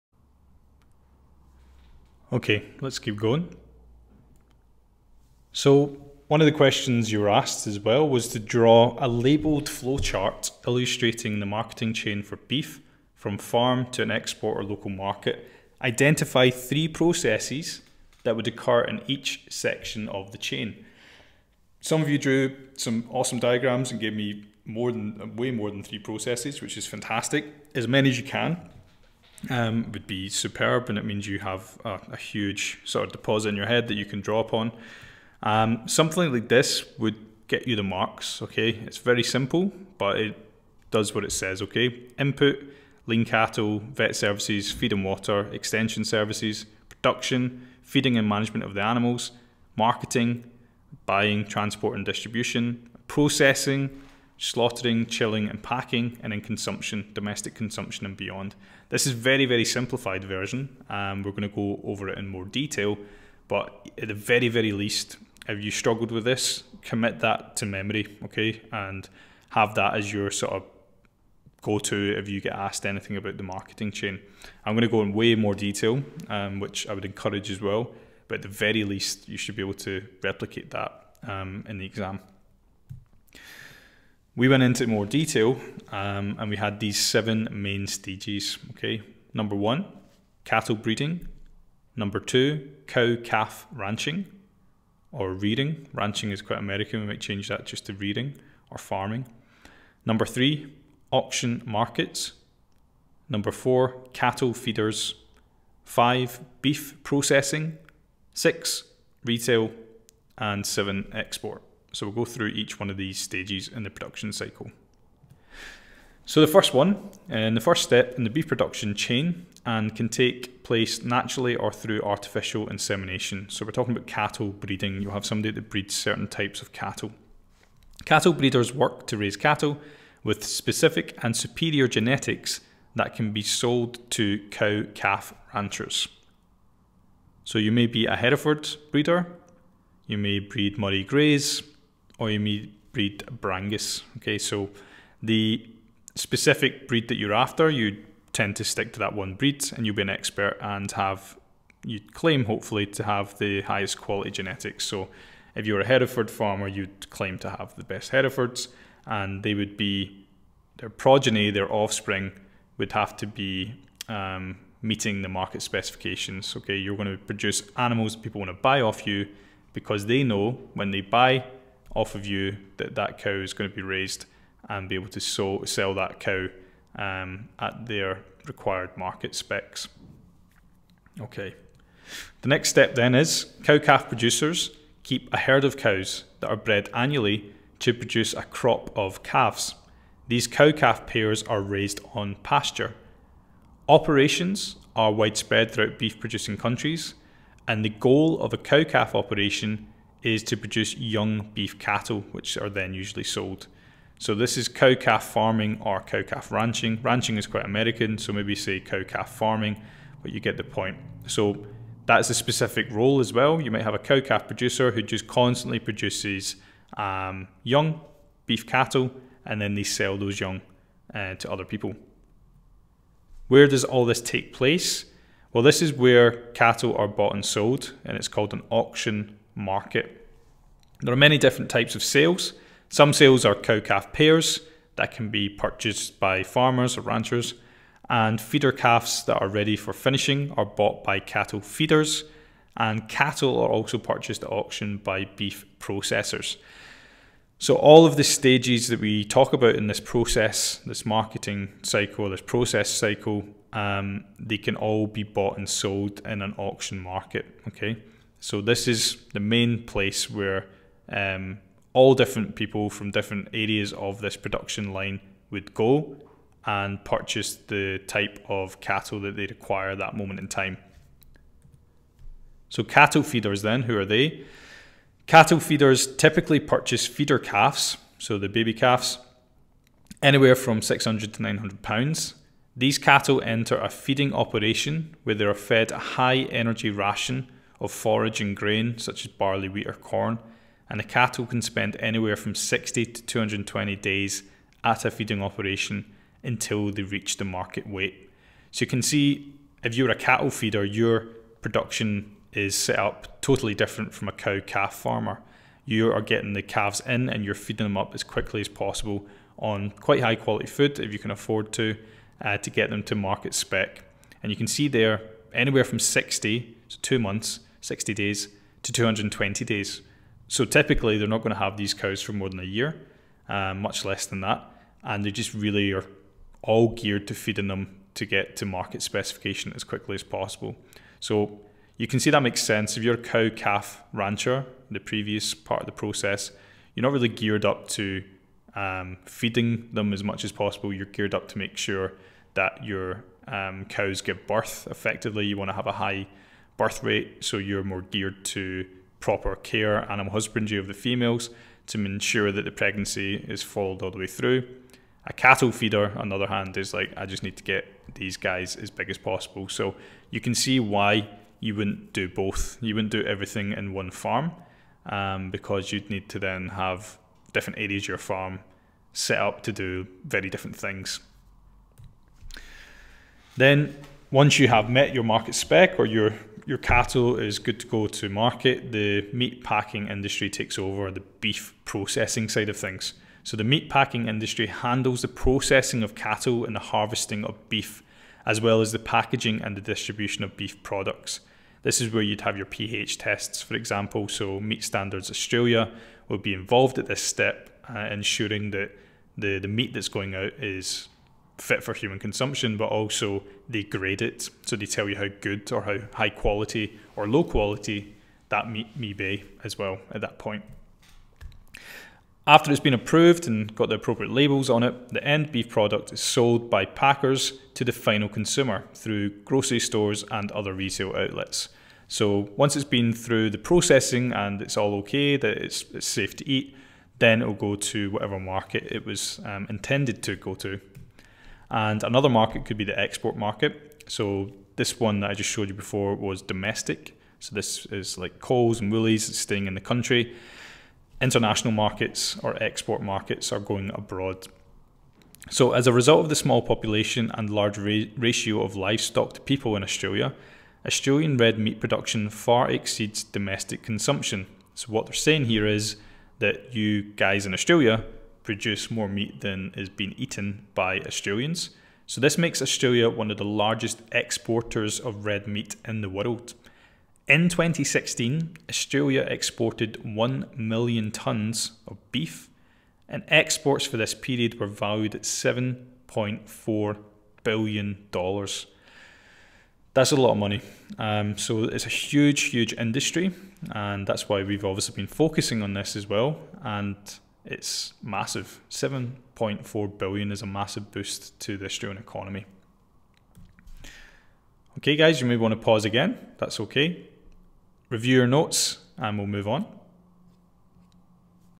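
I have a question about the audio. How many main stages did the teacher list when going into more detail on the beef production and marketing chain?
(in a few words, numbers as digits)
7.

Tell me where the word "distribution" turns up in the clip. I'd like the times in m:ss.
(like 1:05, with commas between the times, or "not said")
0:52, 6:29.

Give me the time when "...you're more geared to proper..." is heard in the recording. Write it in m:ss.
5:47.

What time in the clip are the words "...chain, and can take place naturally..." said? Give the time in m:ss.
1:58.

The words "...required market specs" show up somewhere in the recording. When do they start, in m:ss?
2:58.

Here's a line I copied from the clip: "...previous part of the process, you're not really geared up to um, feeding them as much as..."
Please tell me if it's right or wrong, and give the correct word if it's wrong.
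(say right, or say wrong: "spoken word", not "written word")
right.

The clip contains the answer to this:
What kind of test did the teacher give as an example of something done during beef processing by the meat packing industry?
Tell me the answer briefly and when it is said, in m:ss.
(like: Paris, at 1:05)
pH tests, at 6:32.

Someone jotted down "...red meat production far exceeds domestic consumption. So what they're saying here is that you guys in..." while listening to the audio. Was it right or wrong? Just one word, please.
right.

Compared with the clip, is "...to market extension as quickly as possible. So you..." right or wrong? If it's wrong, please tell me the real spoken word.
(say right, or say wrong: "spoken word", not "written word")
wrong: "specification", not "extension".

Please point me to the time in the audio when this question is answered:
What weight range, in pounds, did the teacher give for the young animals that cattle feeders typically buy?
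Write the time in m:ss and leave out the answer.
4:40.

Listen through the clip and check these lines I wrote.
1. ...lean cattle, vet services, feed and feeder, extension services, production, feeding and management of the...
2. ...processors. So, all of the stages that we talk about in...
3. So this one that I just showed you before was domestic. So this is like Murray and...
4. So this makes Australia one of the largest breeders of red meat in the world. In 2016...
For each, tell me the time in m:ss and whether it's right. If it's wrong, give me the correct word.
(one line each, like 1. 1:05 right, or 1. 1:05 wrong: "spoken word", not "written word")
1. 0:43 wrong: "water", not "feeder"
2. 4:05 right
3. 7:14 wrong: "Coles", not "Murray"
4. 7:42 wrong: "exporters", not "breeders".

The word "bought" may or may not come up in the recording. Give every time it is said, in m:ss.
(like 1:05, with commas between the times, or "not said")
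3:47, 4:00, 4:15.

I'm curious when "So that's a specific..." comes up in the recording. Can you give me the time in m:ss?
3:31.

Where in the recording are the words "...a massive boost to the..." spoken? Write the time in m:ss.
8:10.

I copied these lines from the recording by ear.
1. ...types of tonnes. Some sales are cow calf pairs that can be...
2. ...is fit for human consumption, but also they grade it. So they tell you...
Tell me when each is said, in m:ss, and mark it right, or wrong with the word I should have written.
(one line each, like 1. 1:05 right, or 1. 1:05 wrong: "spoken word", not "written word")
1. 3:51 wrong: "sales", not "tonnes"
2. 6:40 right.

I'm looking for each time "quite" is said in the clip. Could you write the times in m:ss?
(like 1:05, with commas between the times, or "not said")
1:36, 3:27, 5:09.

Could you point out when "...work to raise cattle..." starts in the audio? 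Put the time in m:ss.
2:08.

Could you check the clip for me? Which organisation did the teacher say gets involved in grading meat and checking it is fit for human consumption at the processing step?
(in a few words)
Meat Standards Australia.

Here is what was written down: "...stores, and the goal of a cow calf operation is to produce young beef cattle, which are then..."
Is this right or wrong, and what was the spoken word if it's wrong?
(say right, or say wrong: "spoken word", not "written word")
wrong: "countries", not "stores".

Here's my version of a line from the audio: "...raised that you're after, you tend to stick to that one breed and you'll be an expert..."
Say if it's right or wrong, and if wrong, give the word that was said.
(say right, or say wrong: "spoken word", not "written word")
wrong: "breed", not "raised".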